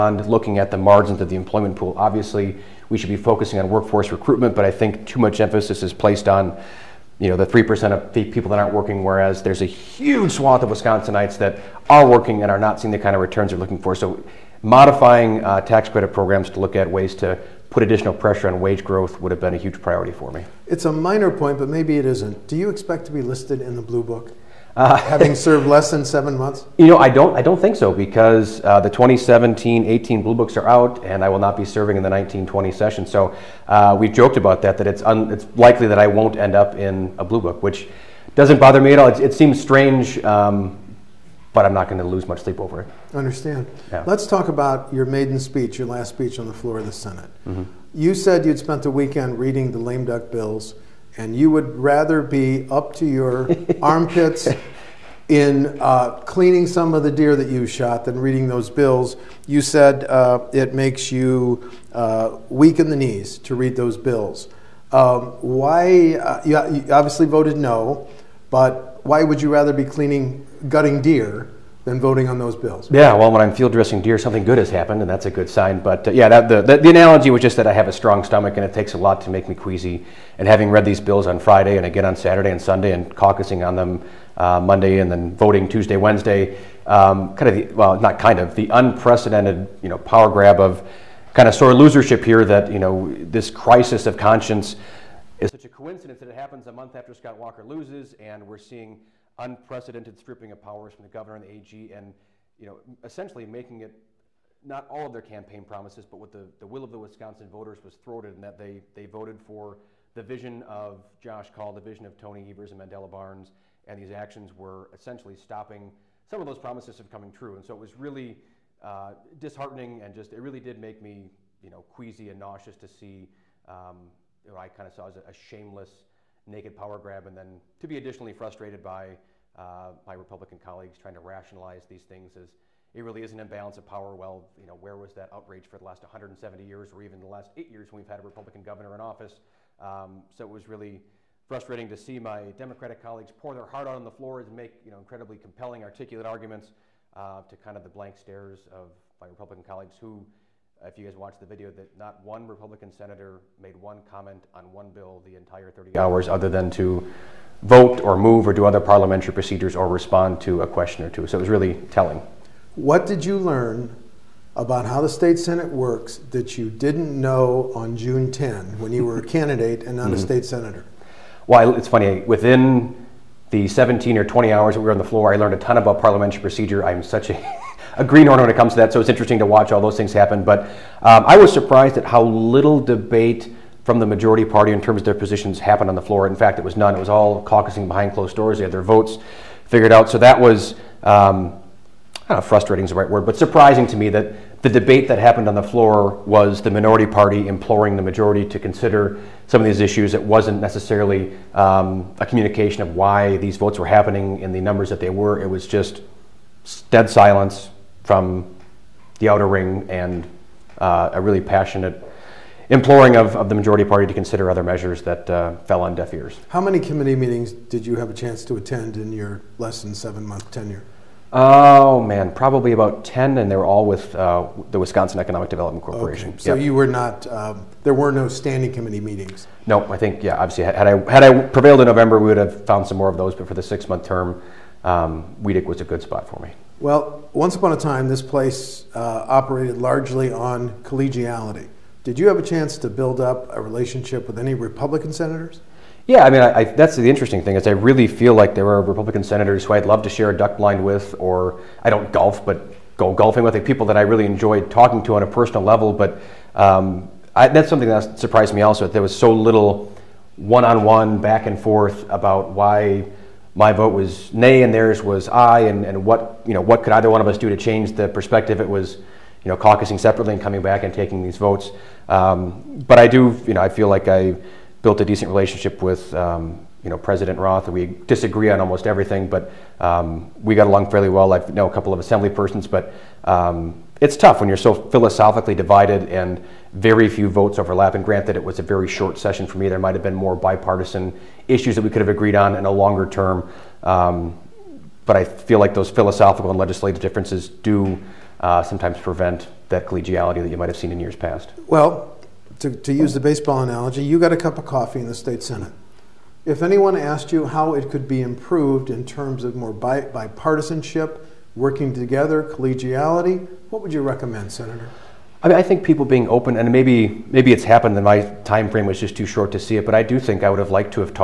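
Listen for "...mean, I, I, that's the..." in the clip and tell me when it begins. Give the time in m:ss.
4:06.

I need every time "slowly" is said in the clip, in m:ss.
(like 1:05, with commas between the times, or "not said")
not said.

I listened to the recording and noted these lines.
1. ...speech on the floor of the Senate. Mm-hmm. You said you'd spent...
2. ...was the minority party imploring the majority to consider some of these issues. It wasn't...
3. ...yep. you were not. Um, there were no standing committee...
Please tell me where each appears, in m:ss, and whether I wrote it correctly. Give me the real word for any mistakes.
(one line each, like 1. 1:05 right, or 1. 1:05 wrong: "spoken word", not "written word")
1. 0:46 right
2. 3:16 right
3. 3:46 right.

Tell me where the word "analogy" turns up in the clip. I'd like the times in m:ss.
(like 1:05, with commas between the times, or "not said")
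1:16, 5:03.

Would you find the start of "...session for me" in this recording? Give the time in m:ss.
4:49.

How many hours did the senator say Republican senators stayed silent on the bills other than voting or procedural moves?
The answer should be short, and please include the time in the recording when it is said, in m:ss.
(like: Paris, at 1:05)
30, at 2:35.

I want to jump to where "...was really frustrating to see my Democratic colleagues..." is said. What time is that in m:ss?
2:20.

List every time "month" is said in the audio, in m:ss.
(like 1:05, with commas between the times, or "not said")
0:26, 1:36, 3:40, 3:53.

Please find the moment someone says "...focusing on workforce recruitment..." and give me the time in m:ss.
0:03.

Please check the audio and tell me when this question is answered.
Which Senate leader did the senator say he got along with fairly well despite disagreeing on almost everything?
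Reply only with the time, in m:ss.
4:36.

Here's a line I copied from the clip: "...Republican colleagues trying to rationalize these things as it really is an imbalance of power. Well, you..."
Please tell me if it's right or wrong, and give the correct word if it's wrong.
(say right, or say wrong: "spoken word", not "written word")
right.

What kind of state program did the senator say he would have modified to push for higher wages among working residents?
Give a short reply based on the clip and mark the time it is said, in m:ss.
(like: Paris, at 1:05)
tax credit programs, at 0:15.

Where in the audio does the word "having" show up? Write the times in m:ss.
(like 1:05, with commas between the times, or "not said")
0:24, 1:20.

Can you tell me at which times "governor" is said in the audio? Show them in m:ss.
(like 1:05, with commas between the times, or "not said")
1:41, 2:18.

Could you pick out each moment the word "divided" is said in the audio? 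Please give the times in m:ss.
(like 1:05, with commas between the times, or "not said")
4:45.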